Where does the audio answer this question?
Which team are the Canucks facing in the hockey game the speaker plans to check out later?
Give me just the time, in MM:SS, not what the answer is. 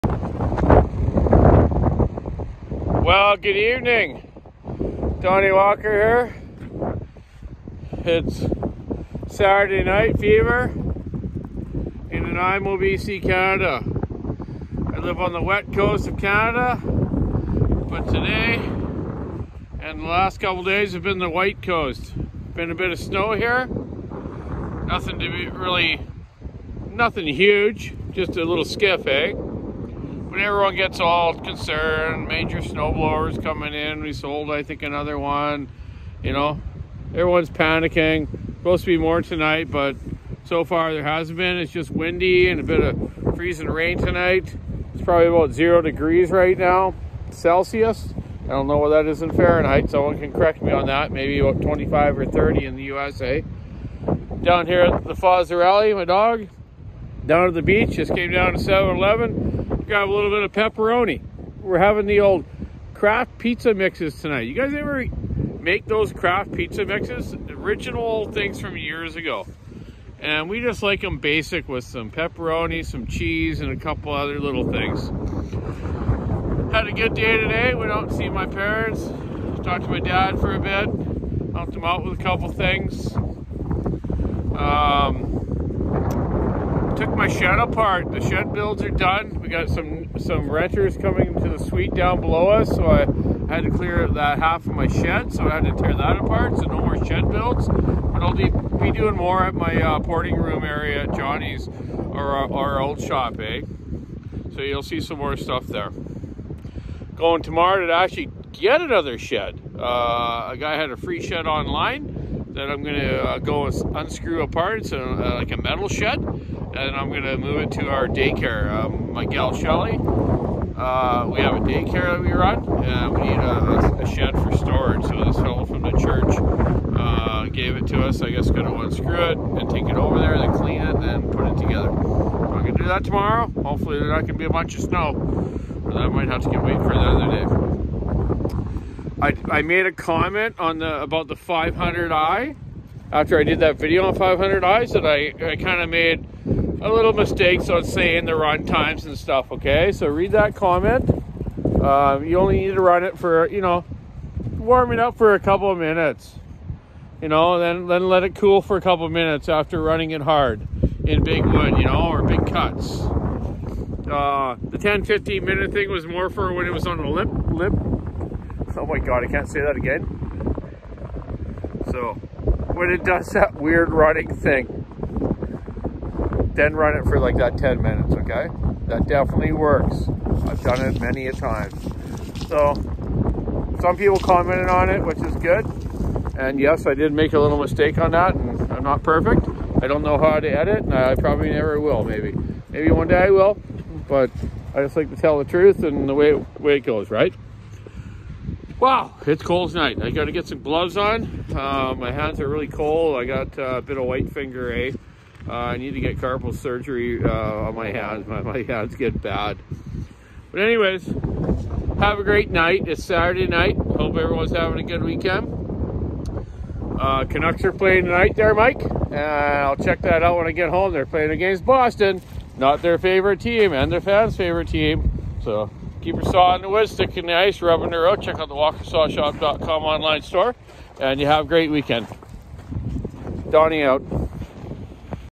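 03:41.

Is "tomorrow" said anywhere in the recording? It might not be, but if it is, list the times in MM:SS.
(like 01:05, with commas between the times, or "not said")
01:47, 02:13.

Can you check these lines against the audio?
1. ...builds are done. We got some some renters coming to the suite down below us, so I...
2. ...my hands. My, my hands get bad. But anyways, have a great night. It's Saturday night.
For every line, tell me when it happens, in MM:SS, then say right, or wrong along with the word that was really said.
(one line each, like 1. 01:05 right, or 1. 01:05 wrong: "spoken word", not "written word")
1. 01:28 right
2. 03:27 right.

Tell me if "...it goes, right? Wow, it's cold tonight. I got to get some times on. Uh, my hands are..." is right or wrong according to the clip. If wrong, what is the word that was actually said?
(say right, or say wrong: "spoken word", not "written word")
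wrong: "gloves", not "times".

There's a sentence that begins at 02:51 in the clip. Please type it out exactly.
So when it does that weird running thing, then run it for like that 10 minutes, okay?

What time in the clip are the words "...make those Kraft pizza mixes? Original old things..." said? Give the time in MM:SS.
01:05.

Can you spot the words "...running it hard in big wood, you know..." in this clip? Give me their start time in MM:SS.
02:39.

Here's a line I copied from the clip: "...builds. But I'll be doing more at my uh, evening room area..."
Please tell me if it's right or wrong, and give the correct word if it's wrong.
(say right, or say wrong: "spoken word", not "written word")
wrong: "porting", not "evening".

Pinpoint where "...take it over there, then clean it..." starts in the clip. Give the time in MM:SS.
02:09.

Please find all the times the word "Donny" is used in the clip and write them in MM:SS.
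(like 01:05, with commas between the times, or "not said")
00:05, 03:53.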